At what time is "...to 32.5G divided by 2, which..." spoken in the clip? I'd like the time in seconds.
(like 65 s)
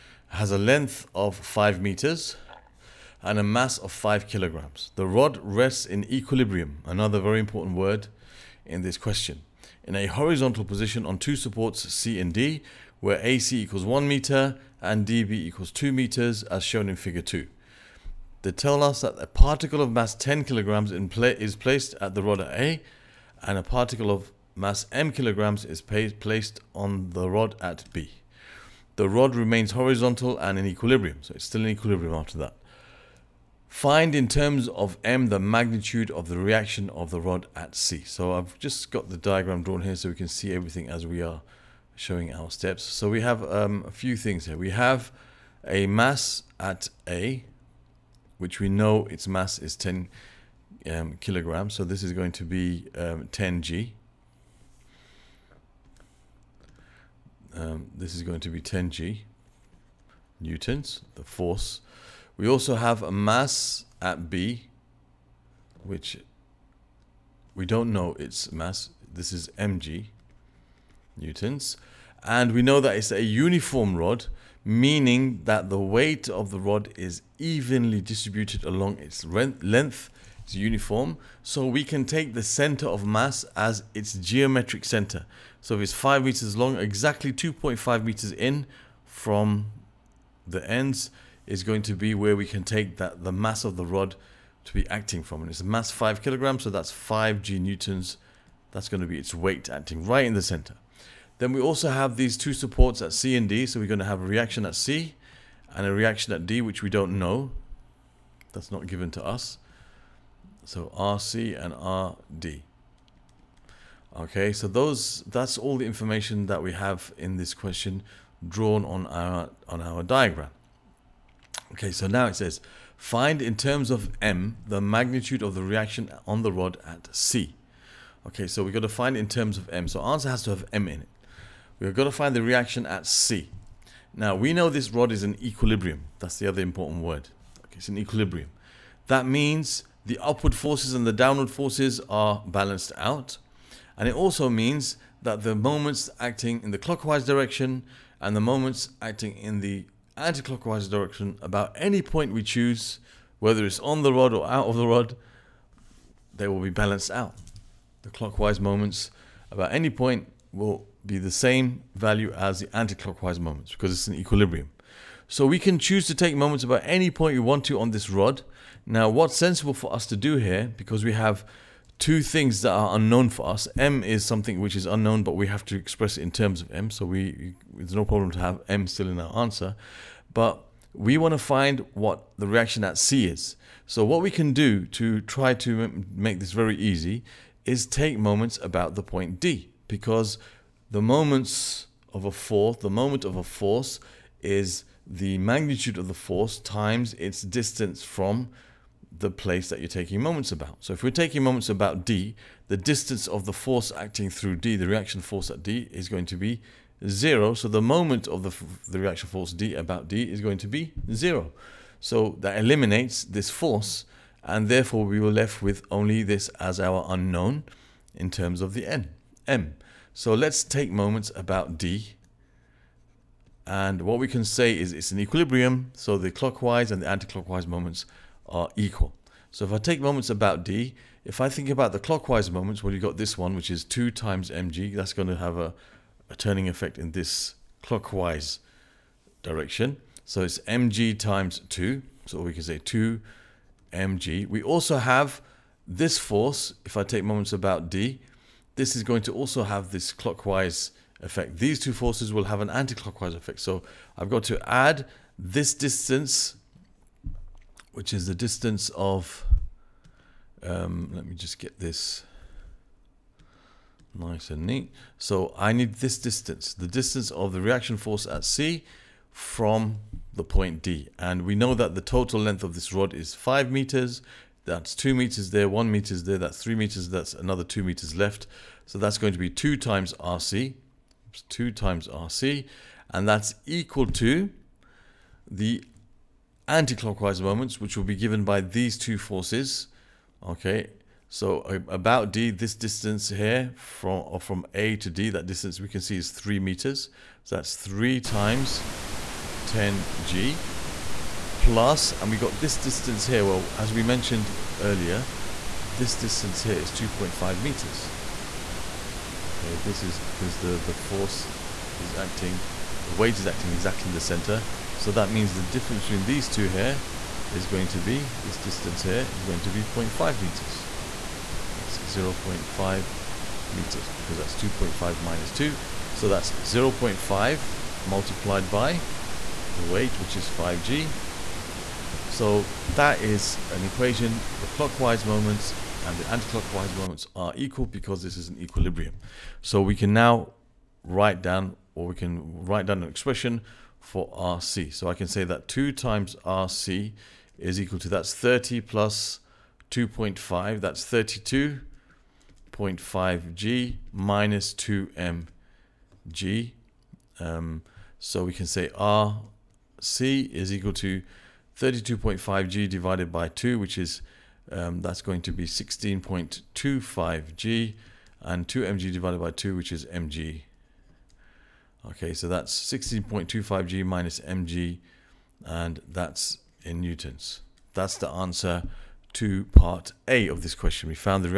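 360 s.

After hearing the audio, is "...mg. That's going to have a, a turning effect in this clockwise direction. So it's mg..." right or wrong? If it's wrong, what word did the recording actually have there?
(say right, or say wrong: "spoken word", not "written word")
right.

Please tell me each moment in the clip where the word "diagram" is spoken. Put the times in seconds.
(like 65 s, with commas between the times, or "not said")
39 s, 120 s.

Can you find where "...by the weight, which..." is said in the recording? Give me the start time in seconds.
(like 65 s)
328 s.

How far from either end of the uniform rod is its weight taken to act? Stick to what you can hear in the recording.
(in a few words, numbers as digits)
2.5 meters.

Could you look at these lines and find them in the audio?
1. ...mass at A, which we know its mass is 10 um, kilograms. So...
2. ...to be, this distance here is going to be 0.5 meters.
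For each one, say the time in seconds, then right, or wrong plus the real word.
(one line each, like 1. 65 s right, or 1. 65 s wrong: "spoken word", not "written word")
1. 45 s right
2. 317 s right.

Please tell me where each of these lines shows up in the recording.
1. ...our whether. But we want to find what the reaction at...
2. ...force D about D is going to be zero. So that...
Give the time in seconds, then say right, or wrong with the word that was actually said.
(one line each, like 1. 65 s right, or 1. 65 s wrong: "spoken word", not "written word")
1. 179 s wrong: "answer", not "whether"
2. 209 s right.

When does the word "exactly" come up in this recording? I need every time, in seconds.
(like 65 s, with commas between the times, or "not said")
86 s, 313 s.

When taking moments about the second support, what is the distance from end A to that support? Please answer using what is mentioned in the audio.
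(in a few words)
3 meters.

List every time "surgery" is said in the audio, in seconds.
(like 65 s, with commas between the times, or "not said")
not said.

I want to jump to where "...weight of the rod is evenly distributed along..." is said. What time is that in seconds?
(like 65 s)
75 s.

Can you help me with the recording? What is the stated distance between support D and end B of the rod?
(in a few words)
2 meters.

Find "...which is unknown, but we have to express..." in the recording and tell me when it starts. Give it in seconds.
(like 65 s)
174 s.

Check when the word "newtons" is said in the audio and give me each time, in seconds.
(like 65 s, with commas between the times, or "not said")
60 s, 71 s, 97 s, 377 s.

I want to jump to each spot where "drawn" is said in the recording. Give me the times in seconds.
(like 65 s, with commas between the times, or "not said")
39 s, 118 s.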